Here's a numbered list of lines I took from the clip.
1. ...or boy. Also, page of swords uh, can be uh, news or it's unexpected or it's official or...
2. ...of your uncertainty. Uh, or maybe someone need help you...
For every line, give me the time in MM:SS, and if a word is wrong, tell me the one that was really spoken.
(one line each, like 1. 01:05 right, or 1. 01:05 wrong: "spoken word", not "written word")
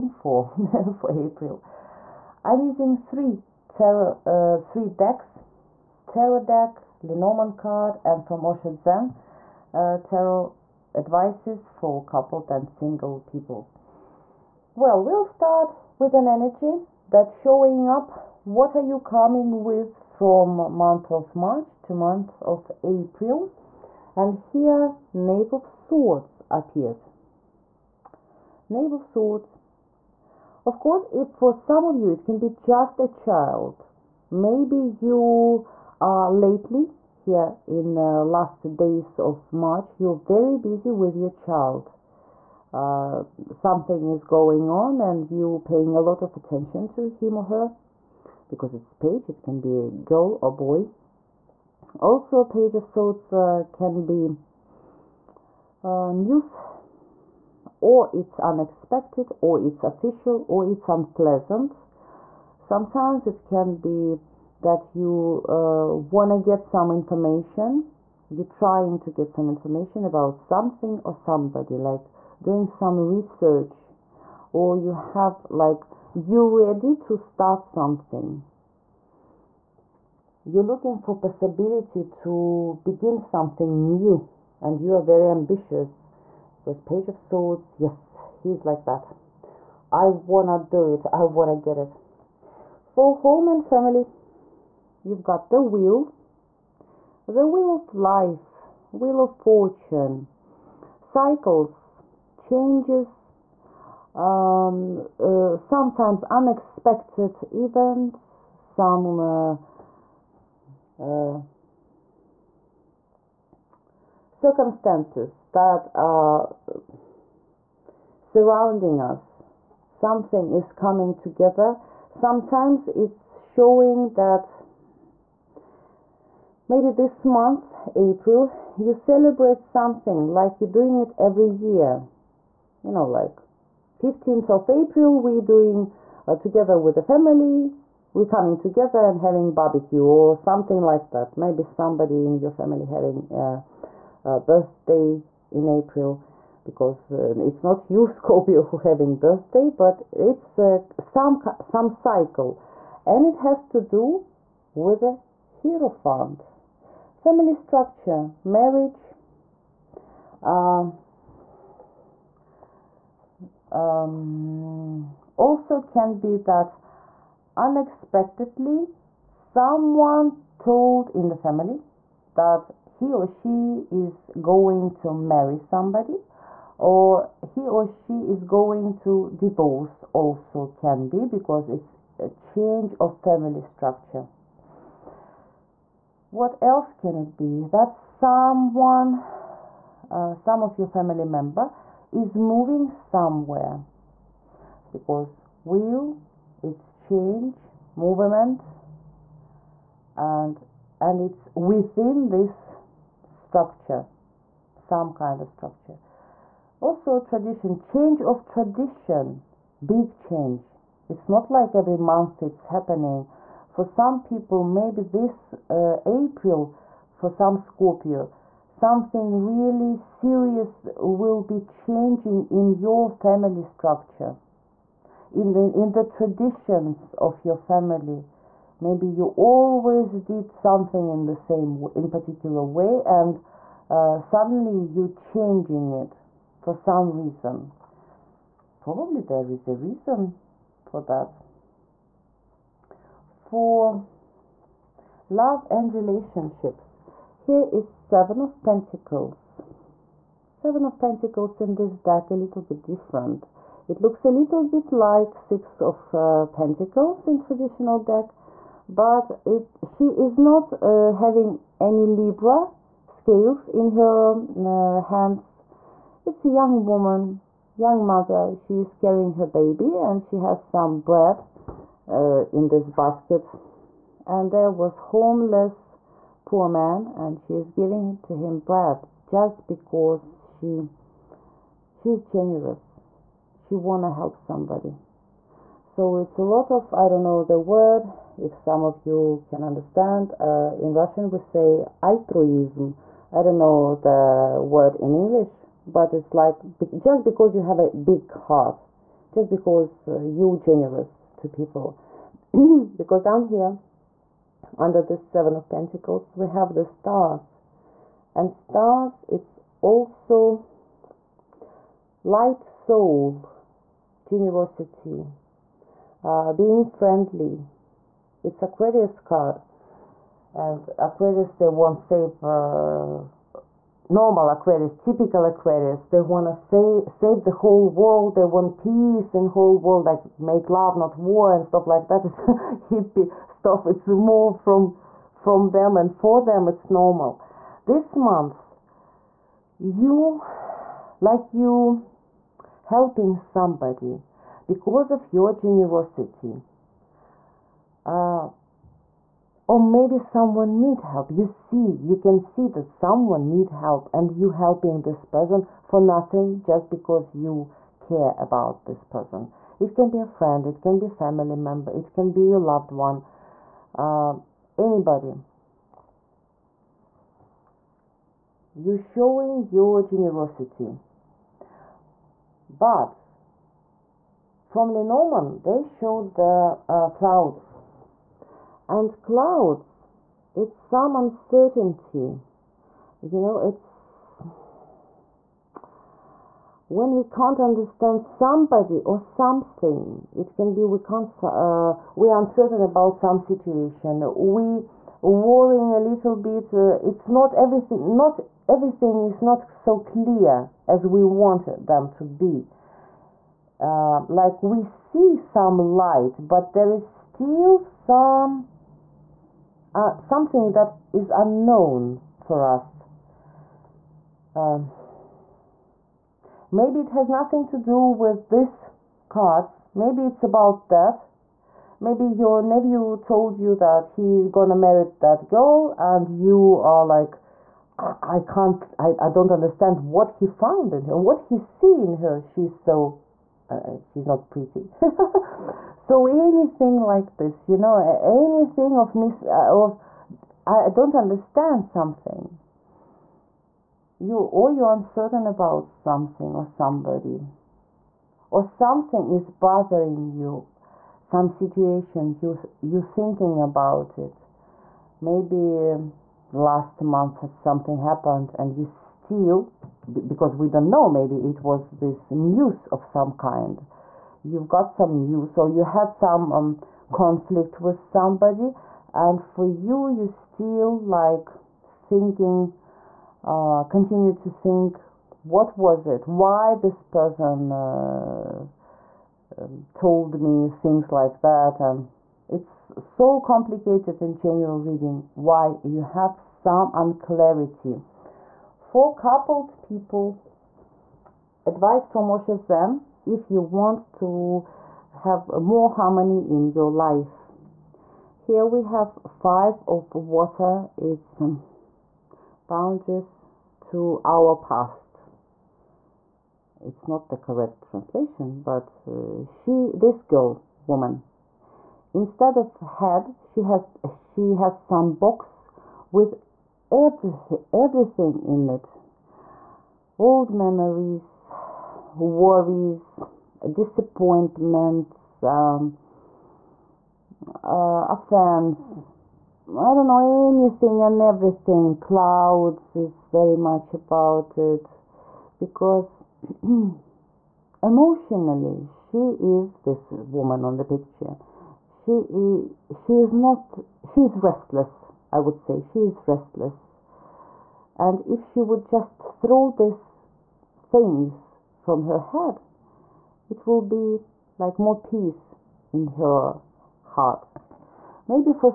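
1. 00:50 right
2. 05:45 wrong: "generosity", not "uncertainty".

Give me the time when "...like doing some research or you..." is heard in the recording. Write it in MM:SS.
01:11.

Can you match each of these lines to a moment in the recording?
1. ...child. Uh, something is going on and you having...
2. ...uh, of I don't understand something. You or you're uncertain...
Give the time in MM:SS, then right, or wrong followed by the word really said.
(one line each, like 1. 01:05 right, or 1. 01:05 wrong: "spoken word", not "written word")
1. 00:41 wrong: "paying", not "having"
2. 07:19 right.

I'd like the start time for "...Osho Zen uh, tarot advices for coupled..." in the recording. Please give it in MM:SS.
00:08.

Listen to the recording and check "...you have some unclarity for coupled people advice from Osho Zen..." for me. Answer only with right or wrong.
right.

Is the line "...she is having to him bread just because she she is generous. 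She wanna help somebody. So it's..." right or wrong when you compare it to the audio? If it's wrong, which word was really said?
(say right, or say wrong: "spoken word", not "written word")
wrong: "giving", not "having".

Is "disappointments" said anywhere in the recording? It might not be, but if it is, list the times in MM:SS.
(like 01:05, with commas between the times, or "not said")
08:43.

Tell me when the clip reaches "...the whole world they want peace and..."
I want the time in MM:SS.
05:27.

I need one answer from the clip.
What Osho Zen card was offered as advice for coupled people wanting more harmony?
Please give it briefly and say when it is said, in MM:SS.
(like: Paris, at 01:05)
Five of Water, at 08:19.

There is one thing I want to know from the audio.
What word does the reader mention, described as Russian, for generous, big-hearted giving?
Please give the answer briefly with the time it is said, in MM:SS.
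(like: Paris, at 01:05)
Altruism, at 04:52.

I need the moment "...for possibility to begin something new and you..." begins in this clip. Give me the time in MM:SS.
01:20.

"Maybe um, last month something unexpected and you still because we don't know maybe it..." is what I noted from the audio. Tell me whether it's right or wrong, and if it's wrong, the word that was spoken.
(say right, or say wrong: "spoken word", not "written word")
wrong: "happened", not "unexpected".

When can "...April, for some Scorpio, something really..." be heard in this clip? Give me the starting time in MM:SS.
03:36.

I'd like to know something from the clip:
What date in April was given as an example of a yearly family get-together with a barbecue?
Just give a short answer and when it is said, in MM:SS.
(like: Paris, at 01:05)
15th of April, at 02:13.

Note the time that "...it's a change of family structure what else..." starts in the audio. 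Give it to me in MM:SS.
03:01.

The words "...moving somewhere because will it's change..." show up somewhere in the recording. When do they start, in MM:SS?
03:12.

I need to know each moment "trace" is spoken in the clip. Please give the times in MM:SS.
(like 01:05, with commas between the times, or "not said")
not said.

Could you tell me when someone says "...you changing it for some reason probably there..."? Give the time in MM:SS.
03:54.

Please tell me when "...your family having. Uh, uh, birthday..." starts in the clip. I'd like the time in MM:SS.
02:22.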